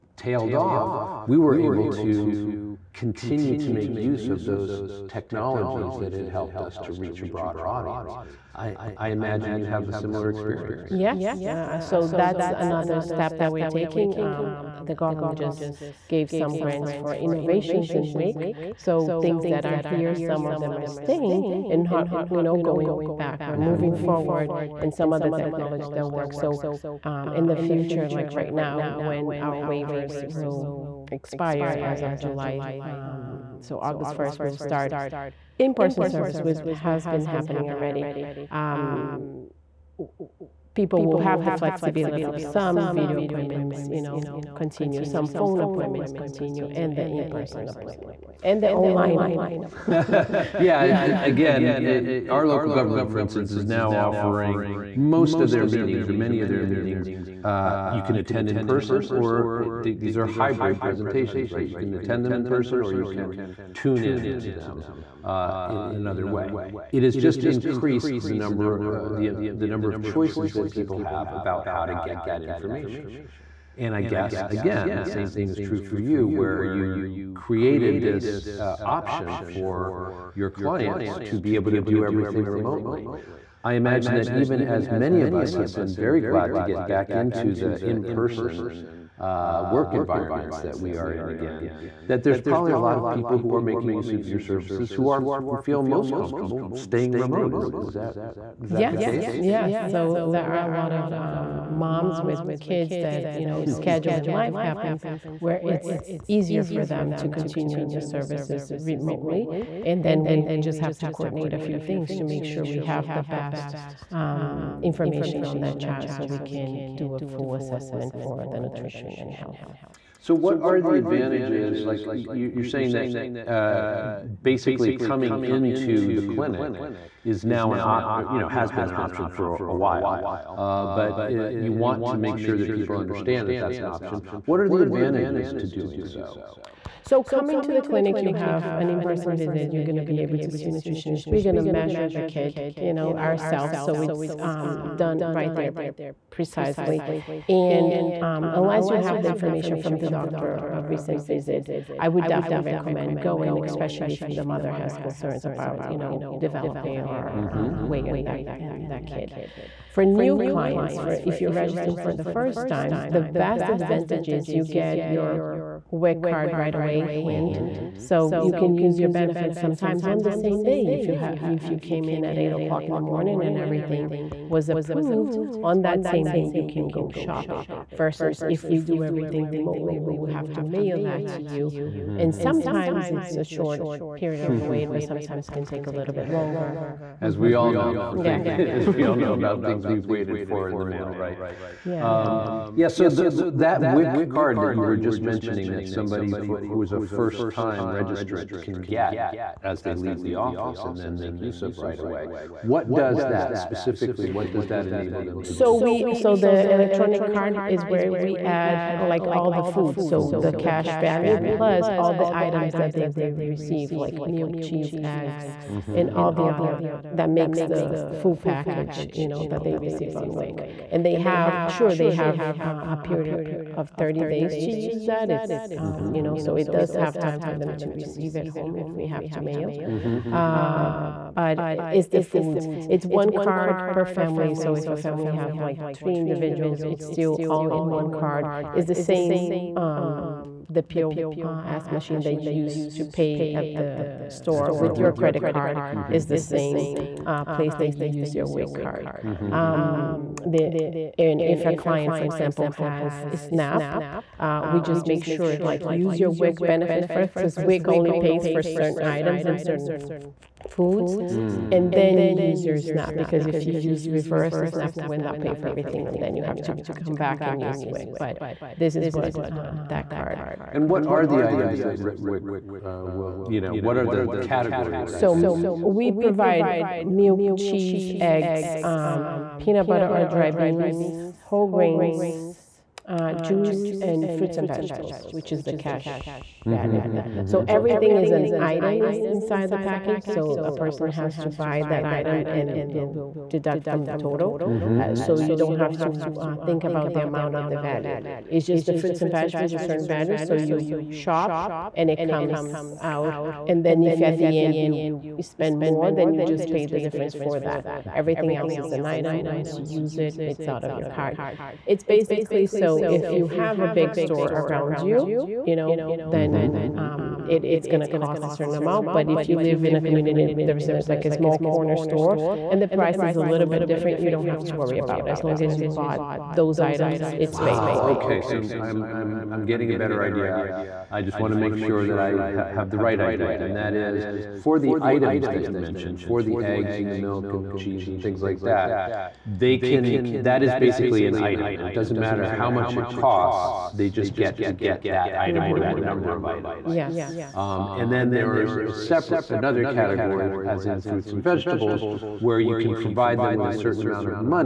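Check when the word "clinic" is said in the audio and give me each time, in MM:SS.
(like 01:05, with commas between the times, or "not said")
02:06, 02:17.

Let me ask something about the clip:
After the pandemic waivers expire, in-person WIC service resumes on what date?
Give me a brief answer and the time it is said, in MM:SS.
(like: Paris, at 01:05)
August 1st, at 00:33.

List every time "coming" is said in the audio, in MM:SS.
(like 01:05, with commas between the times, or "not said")
02:04, 02:17.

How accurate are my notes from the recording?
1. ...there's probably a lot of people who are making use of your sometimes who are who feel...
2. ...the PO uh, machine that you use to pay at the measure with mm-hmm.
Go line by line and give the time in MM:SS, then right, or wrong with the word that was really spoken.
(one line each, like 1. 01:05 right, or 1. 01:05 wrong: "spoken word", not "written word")
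1. 01:32 wrong: "services", not "sometimes"
2. 04:00 wrong: "store", not "measure".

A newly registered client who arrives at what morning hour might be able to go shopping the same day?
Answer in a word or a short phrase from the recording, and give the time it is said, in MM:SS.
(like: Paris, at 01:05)
8 o'clock, at 02:52.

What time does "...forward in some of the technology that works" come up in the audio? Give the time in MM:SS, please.
00:23.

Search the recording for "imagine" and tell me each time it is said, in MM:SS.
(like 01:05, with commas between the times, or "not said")
00:09, 01:23.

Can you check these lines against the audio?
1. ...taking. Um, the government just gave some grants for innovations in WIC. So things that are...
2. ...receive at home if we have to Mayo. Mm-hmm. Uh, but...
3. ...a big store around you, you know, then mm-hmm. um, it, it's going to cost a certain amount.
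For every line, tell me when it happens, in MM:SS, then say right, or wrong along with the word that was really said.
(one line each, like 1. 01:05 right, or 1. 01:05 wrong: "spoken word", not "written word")
1. 00:13 right
2. 03:47 right
3. 05:13 right.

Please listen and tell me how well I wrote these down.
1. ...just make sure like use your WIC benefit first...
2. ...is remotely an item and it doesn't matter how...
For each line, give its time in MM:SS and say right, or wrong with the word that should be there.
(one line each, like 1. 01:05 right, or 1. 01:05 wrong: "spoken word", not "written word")
1. 04:14 right
2. 05:40 wrong: "basically", not "remotely".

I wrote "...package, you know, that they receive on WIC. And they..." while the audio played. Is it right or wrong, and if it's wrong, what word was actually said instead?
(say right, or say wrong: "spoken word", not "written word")
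right.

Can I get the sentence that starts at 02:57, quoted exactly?
Versus if we do everything remotely, we will have to mail that to you, mm-hmm.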